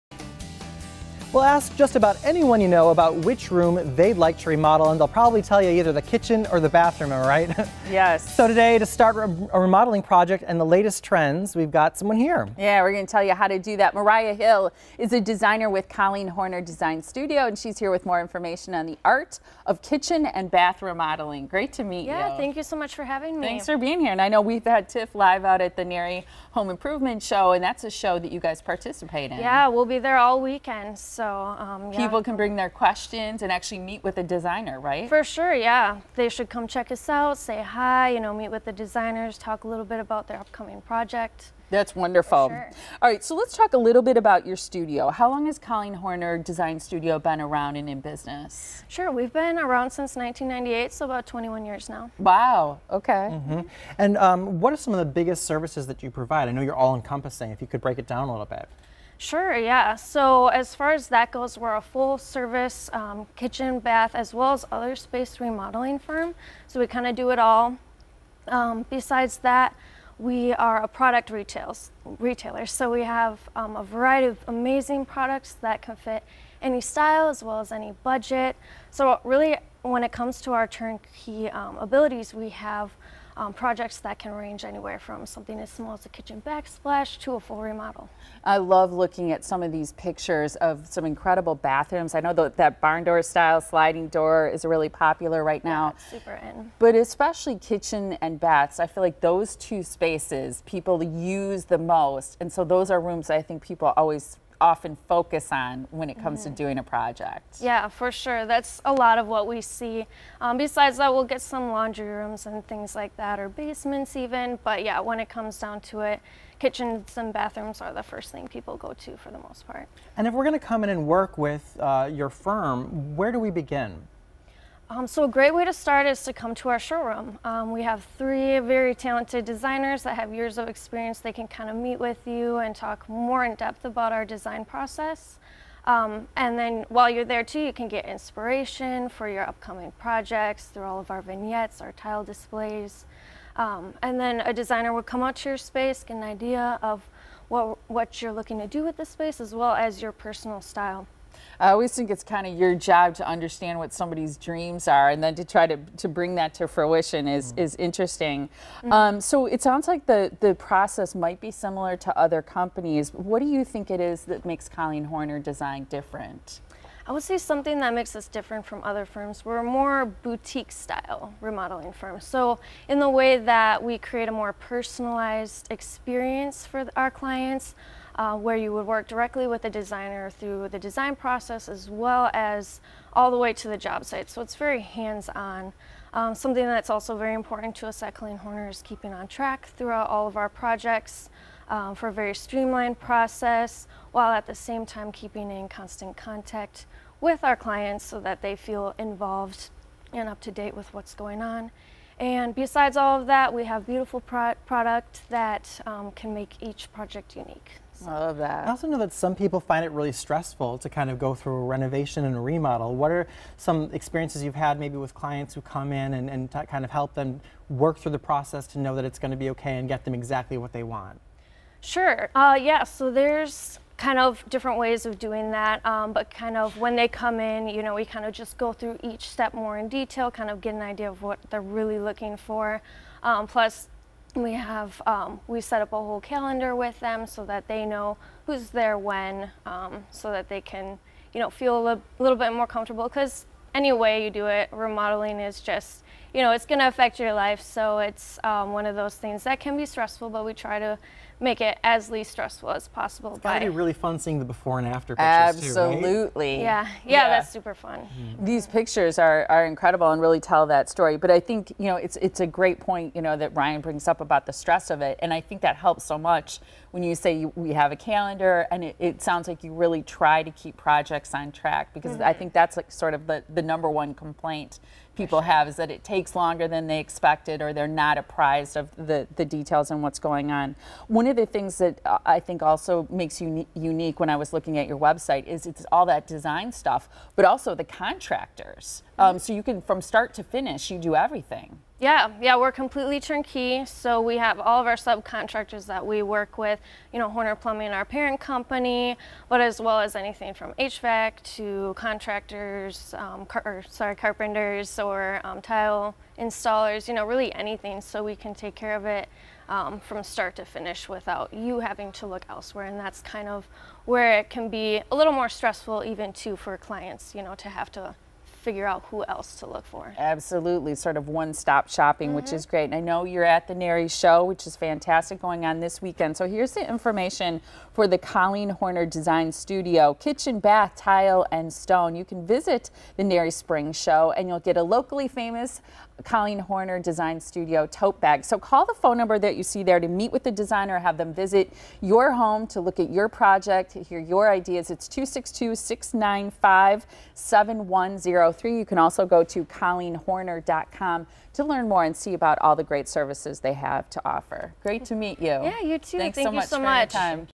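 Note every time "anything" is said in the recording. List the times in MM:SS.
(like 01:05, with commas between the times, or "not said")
05:00, 05:07.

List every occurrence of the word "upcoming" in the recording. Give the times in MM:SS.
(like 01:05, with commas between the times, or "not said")
00:40, 02:19.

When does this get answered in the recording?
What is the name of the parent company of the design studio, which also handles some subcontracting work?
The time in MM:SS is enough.
04:57.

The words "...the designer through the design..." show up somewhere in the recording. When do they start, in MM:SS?
02:59.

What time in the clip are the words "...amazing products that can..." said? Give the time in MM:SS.
01:14.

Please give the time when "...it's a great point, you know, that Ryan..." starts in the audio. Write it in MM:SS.
04:22.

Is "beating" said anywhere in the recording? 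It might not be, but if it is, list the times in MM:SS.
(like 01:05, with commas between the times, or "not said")
not said.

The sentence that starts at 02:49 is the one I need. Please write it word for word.
We're a more boutique style remodeling firm.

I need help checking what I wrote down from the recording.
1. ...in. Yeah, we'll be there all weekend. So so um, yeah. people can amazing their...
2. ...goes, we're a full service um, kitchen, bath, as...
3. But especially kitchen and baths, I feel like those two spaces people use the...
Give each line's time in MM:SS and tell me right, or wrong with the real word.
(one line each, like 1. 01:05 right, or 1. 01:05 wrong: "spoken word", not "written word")
1. 00:29 wrong: "bring", not "amazing"
2. 01:01 right
3. 01:36 right.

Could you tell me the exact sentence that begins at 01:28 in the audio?
I love looking at some of these pictures of some incredible bathrooms.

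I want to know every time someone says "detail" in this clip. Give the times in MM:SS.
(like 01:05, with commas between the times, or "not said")
03:49, 04:39.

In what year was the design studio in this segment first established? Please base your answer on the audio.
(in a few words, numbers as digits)
1998.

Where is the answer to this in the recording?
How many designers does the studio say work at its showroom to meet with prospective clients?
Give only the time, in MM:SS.
02:08.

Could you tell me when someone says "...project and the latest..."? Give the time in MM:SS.
00:10.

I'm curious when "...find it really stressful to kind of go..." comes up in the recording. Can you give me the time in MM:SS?
03:29.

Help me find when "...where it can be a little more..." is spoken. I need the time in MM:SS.
05:14.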